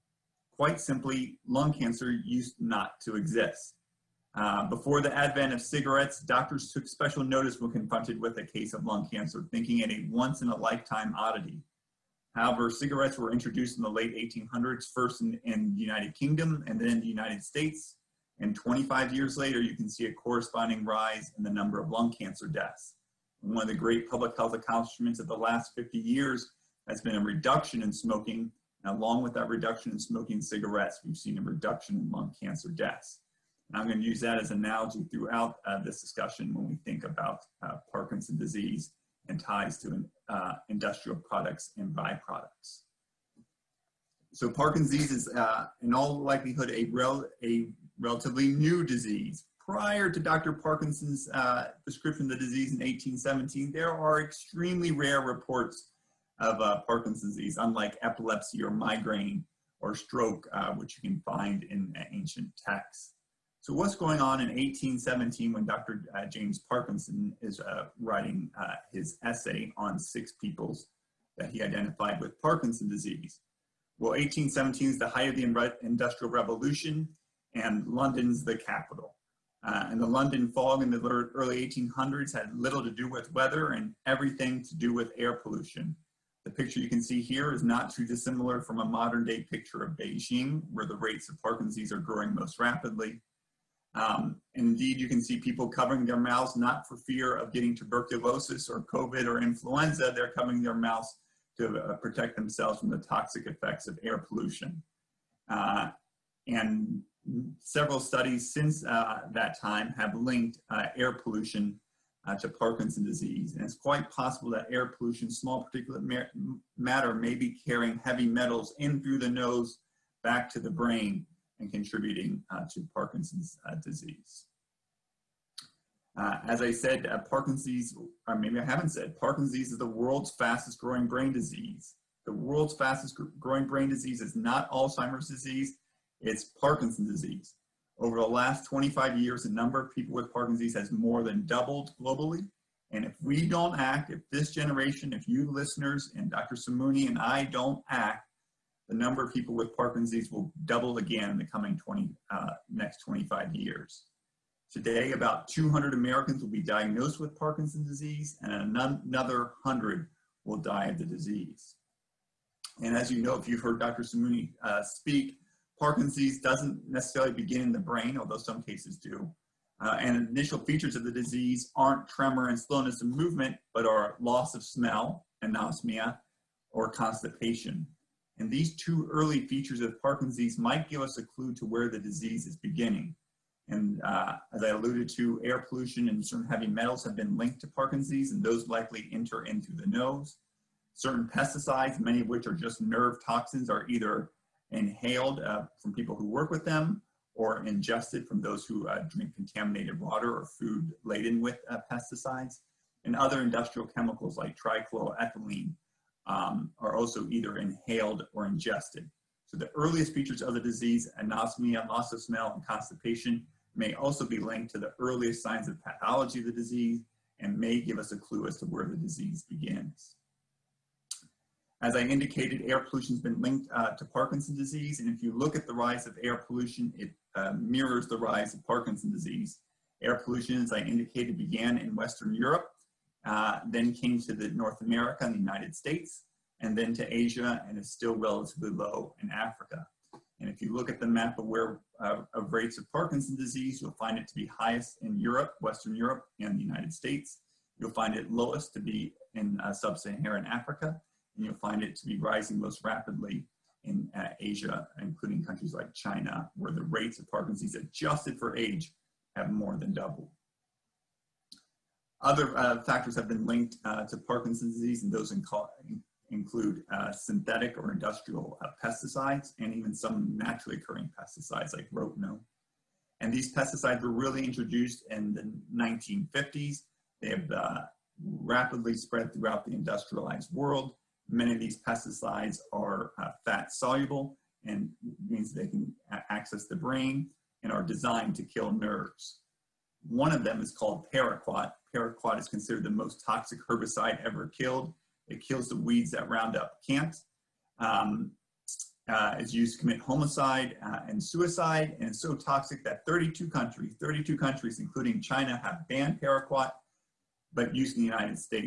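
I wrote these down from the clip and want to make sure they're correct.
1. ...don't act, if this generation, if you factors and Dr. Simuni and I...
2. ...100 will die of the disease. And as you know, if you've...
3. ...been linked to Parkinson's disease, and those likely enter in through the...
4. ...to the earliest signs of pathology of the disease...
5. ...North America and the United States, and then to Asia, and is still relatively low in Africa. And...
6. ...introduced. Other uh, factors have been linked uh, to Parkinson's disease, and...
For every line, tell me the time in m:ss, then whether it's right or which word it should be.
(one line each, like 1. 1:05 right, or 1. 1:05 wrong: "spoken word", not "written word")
1. 2:23 wrong: "listeners", not "factors"
2. 2:39 right
3. 3:07 right
4. 3:34 right
5. 3:54 right
6. 4:19 wrong: "doubled", not "introduced".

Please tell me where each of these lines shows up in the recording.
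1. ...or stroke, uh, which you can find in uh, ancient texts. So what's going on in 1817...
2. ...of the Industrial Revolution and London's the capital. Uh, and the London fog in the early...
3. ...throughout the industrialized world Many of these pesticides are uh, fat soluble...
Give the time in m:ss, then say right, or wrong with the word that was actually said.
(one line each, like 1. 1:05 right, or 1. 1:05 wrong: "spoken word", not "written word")
1. 0:59 right
2. 1:15 right
3. 4:39 right.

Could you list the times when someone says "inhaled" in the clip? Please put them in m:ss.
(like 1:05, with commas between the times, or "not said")
3:14, 3:27.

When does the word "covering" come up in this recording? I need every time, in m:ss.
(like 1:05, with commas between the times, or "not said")
1:35, 1:40.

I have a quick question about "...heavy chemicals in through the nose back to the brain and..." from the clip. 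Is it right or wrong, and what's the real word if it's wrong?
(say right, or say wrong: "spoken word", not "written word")
wrong: "metals", not "chemicals".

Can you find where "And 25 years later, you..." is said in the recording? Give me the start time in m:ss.
0:18.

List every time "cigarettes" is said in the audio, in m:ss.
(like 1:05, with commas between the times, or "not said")
0:05, 0:12, 0:30.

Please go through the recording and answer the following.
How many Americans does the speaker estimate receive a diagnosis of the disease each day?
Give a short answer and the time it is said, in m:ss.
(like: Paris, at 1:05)
200, at 2:35.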